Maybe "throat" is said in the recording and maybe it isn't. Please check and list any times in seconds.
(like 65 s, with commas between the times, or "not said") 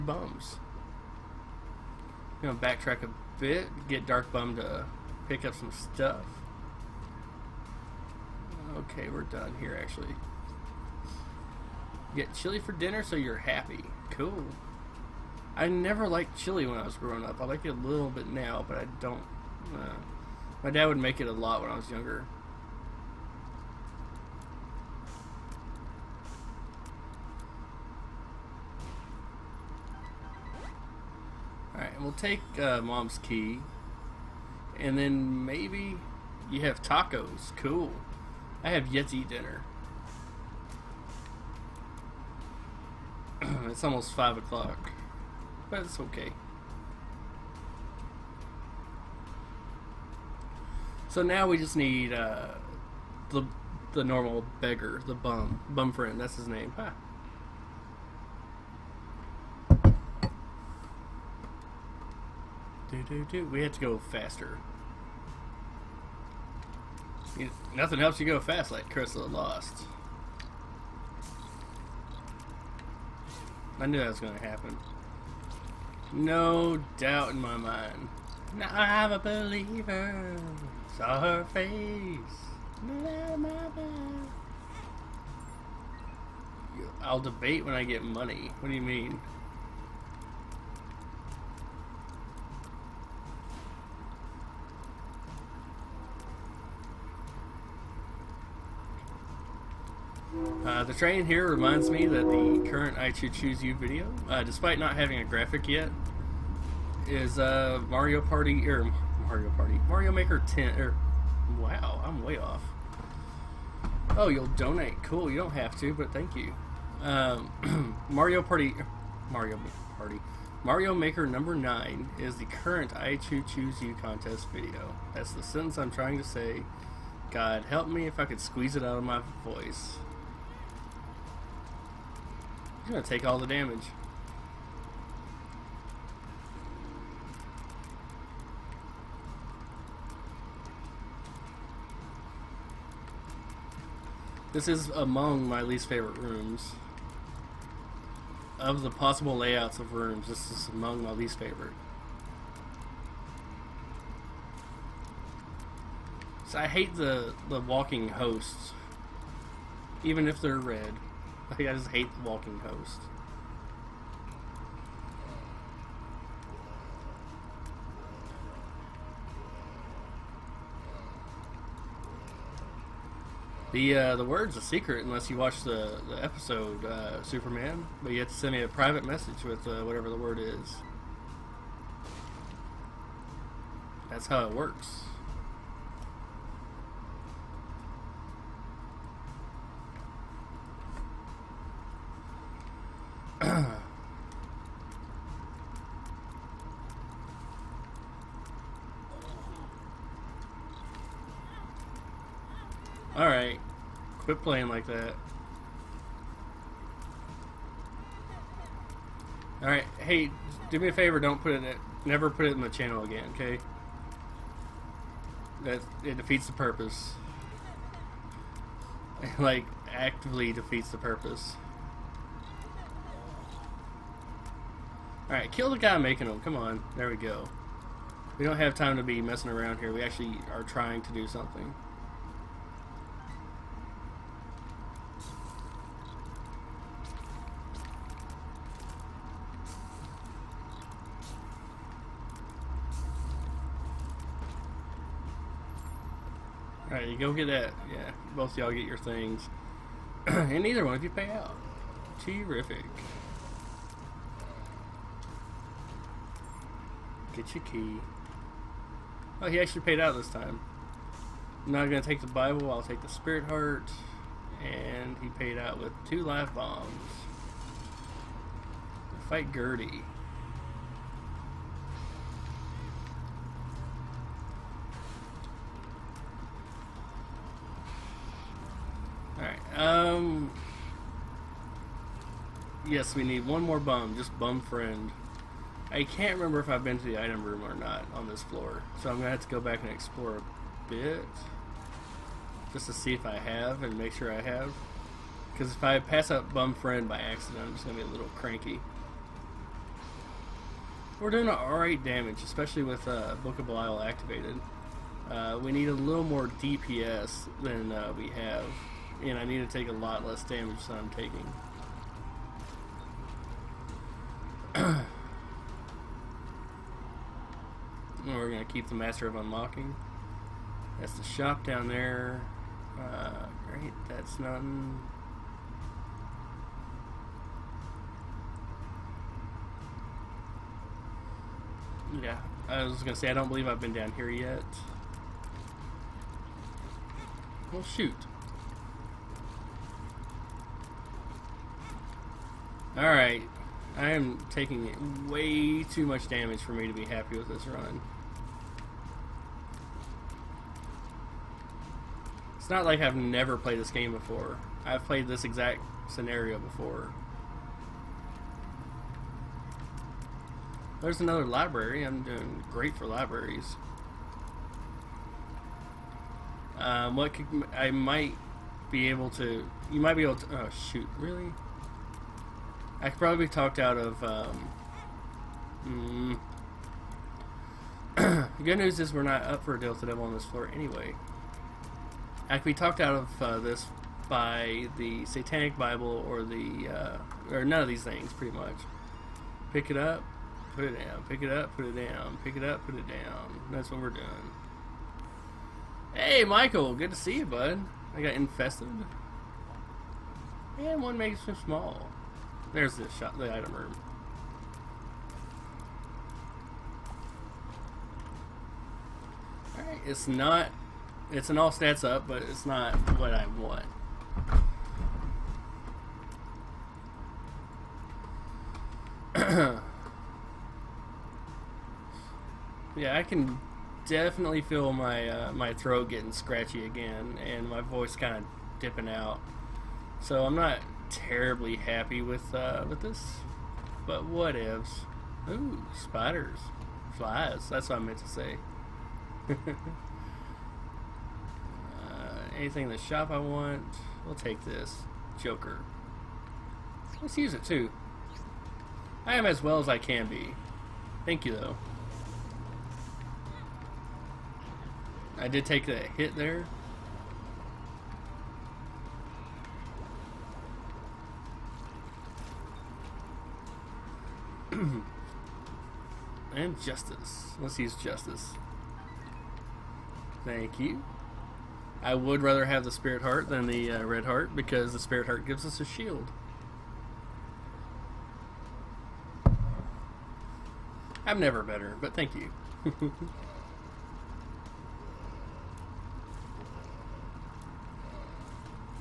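425 s.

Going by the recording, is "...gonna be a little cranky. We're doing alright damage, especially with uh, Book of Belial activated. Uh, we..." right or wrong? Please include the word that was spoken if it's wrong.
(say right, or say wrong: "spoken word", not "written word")
right.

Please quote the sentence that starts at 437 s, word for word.
That's what I meant to say.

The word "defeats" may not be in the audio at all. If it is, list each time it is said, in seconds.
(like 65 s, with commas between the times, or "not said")
216 s, 220 s.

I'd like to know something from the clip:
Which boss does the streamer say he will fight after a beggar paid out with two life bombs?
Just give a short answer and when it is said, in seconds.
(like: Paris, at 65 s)
Gertie, at 269 s.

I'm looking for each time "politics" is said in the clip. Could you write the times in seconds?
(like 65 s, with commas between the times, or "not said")
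not said.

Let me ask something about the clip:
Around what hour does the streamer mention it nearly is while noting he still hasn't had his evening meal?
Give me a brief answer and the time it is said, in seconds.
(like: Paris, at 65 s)
5 o'clock, at 44 s.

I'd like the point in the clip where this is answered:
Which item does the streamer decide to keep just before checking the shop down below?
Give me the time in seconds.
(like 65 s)
318 s.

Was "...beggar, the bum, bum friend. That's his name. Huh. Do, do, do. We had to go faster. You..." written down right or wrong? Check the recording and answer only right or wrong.
right.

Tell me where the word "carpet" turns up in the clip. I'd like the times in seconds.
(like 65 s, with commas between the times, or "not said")
not said.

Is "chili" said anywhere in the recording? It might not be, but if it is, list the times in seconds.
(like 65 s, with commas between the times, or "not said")
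12 s, 16 s.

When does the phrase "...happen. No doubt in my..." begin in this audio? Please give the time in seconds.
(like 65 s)
74 s.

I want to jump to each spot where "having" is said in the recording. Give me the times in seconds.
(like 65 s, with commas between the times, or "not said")
104 s.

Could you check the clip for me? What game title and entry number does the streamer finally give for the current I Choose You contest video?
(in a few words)
Mario Party Mario Maker 9.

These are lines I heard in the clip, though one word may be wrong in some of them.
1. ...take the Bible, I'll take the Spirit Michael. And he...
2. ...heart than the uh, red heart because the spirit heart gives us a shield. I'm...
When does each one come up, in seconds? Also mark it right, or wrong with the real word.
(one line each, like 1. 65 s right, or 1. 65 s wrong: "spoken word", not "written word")
1. 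262 s wrong: "Heart", not "Michael"
2. 473 s right.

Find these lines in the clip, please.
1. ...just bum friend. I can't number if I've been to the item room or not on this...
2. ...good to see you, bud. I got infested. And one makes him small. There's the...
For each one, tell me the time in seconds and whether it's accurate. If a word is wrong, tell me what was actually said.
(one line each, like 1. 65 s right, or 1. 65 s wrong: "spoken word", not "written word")
1. 284 s wrong: "remember", not "number"
2. 396 s right.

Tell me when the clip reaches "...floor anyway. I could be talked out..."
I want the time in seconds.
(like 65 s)
380 s.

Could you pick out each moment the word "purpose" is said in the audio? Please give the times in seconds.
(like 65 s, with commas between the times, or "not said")
216 s, 220 s.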